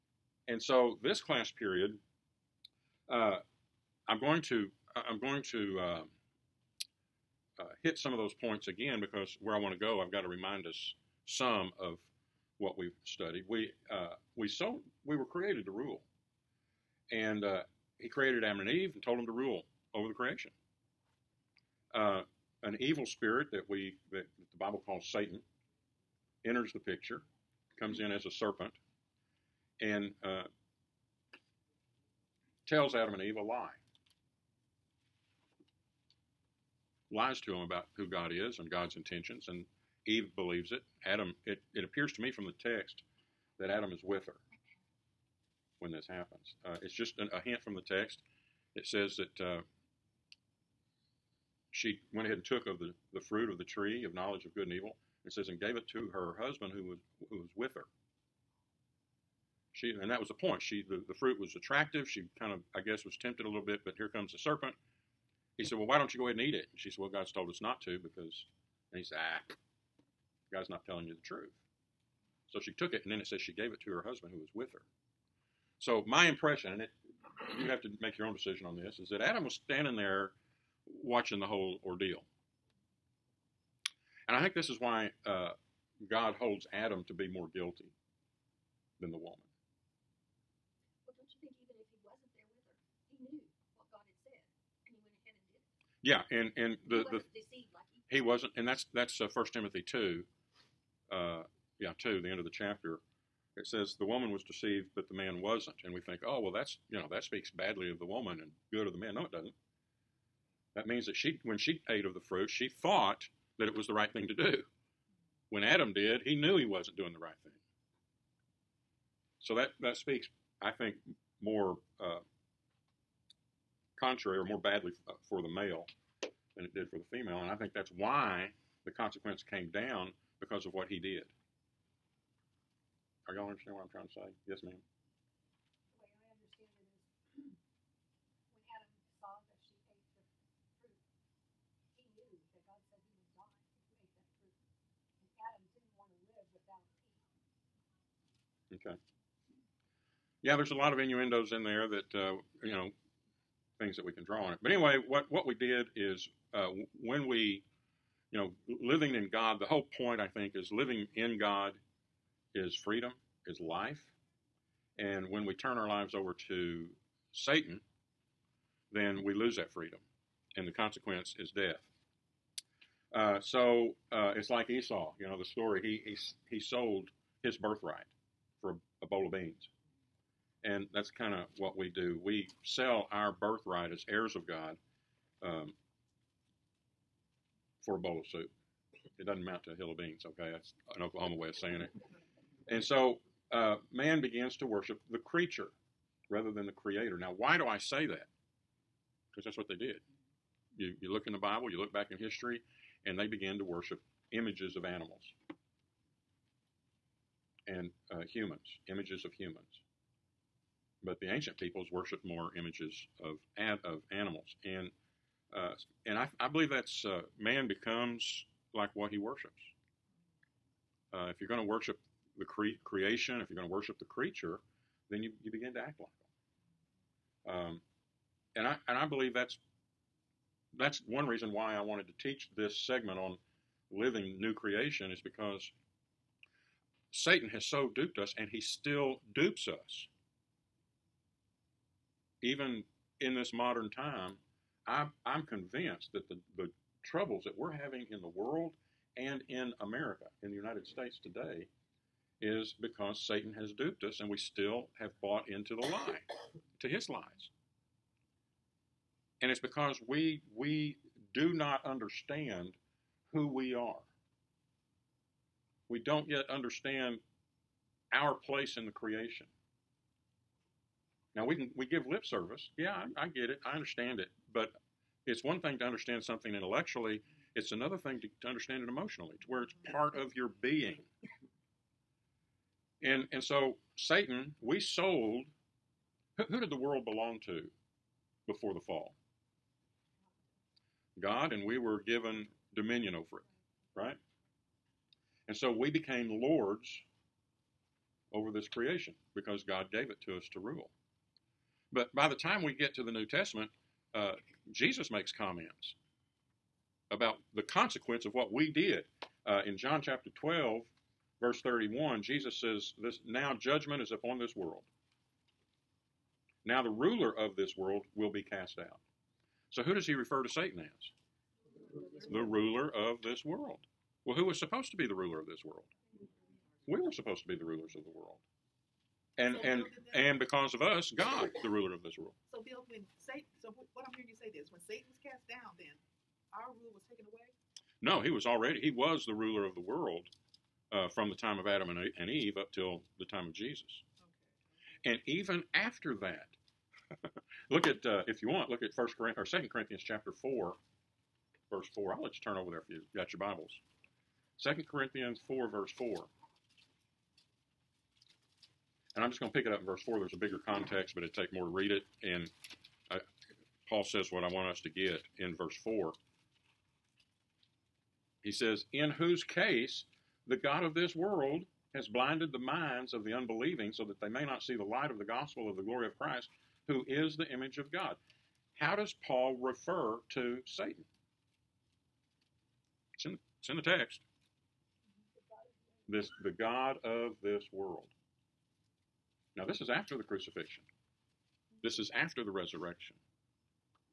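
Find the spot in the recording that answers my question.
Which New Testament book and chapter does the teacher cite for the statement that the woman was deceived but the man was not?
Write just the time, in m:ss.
1:39.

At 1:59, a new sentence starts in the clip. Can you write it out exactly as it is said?
So that, that speaks, I think, more uh, contrary or more badly uh, for the male than it did for the female.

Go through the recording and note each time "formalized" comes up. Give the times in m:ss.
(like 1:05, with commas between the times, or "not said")
not said.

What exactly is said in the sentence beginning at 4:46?
Who, who did the world belong to before the fall?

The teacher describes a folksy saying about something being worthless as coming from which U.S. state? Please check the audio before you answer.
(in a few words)
Oklahoma.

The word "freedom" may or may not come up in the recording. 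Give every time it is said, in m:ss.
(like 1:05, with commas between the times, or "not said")
2:42, 2:49.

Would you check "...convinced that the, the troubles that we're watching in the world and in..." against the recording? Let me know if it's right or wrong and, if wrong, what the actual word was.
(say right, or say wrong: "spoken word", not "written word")
wrong: "having", not "watching".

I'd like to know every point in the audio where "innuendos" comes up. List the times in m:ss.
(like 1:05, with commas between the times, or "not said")
2:30.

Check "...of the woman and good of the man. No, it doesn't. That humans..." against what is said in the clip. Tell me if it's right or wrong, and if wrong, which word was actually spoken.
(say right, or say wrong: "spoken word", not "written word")
wrong: "means", not "humans".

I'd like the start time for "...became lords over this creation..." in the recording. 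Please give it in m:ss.
4:55.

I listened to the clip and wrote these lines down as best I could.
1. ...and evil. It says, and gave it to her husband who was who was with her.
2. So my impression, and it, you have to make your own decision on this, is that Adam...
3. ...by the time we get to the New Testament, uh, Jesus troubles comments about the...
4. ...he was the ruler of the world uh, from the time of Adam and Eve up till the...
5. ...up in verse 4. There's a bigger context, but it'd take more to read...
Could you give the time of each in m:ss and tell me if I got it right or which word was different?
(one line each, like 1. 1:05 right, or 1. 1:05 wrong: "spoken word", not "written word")
1. 0:54 right
2. 1:15 right
3. 5:02 wrong: "makes", not "troubles"
4. 5:38 right
5. 5:59 right.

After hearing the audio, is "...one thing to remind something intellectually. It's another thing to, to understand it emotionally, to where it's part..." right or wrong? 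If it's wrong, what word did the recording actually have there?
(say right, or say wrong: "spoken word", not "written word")
wrong: "understand", not "remind".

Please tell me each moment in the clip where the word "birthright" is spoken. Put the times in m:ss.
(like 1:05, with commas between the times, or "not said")
2:57, 3:03.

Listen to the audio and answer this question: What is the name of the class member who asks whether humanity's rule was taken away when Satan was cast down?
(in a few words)
Bill.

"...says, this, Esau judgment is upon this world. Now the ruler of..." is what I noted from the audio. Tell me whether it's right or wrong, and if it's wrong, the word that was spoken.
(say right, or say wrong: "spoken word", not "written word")
wrong: "Now", not "Esau".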